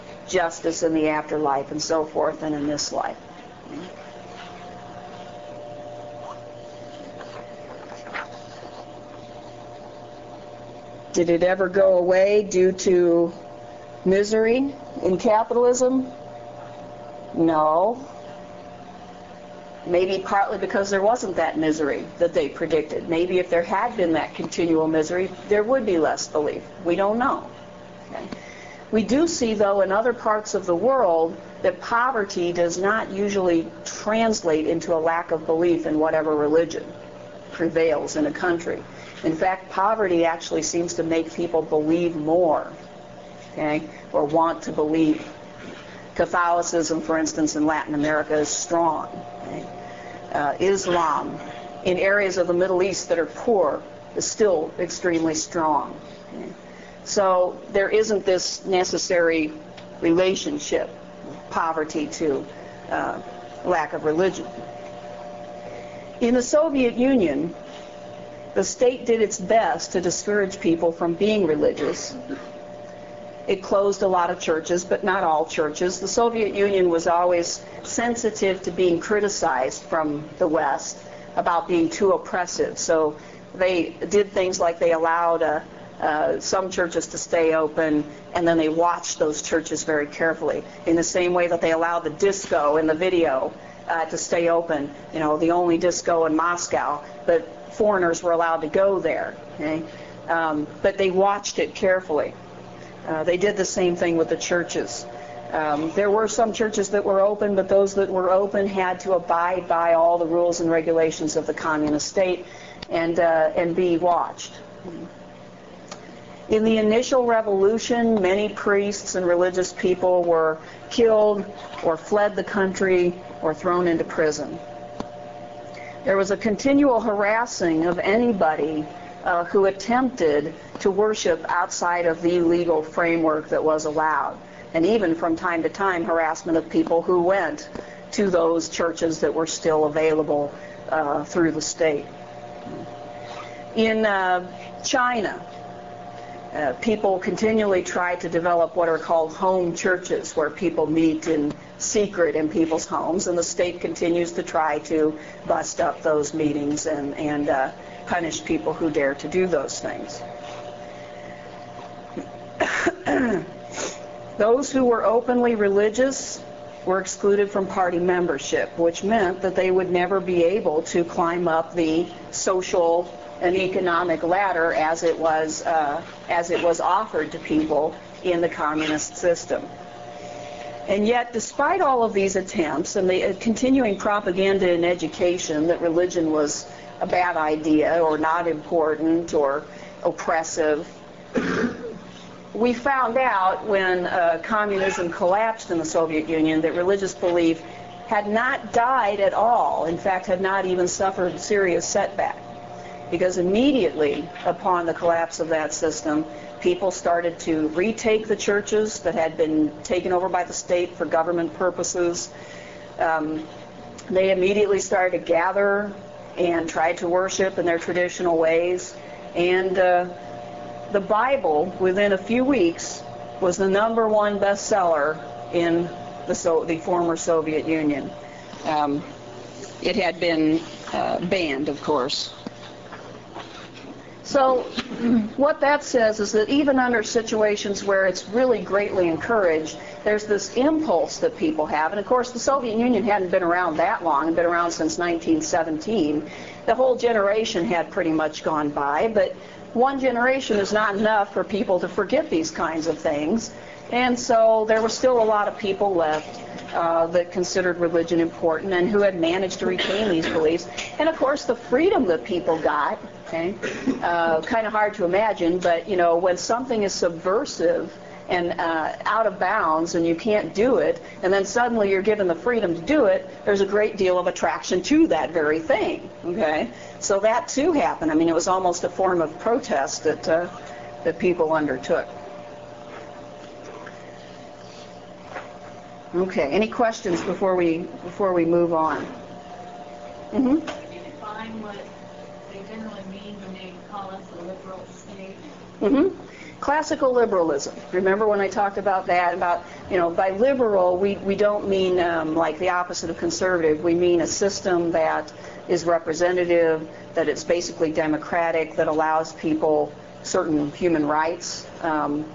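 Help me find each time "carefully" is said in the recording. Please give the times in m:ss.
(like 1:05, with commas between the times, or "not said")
1:30, 1:41.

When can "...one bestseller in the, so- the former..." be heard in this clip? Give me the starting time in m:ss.
3:44.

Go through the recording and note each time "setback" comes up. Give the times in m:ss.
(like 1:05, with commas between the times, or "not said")
3:21.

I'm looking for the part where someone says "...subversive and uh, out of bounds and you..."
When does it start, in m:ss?
4:26.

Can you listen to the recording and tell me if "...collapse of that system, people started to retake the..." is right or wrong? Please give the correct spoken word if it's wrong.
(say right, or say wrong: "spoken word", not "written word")
right.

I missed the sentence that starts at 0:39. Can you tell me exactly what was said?
In fact, poverty actually seems to make people believe more, okay, or want to believe.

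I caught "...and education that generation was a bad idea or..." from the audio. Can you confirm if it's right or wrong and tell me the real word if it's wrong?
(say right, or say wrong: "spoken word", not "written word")
wrong: "religion", not "generation".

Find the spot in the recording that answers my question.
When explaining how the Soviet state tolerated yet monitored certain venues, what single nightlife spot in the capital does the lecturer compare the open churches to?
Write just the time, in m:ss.
1:35.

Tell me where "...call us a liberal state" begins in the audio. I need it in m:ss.
4:53.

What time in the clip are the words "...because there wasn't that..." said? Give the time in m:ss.
0:20.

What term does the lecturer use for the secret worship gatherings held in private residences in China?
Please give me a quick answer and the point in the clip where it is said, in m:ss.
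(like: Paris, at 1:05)
home churches, at 2:29.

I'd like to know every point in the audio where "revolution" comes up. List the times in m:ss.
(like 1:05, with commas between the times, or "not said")
1:57.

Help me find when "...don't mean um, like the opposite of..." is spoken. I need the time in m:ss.
5:01.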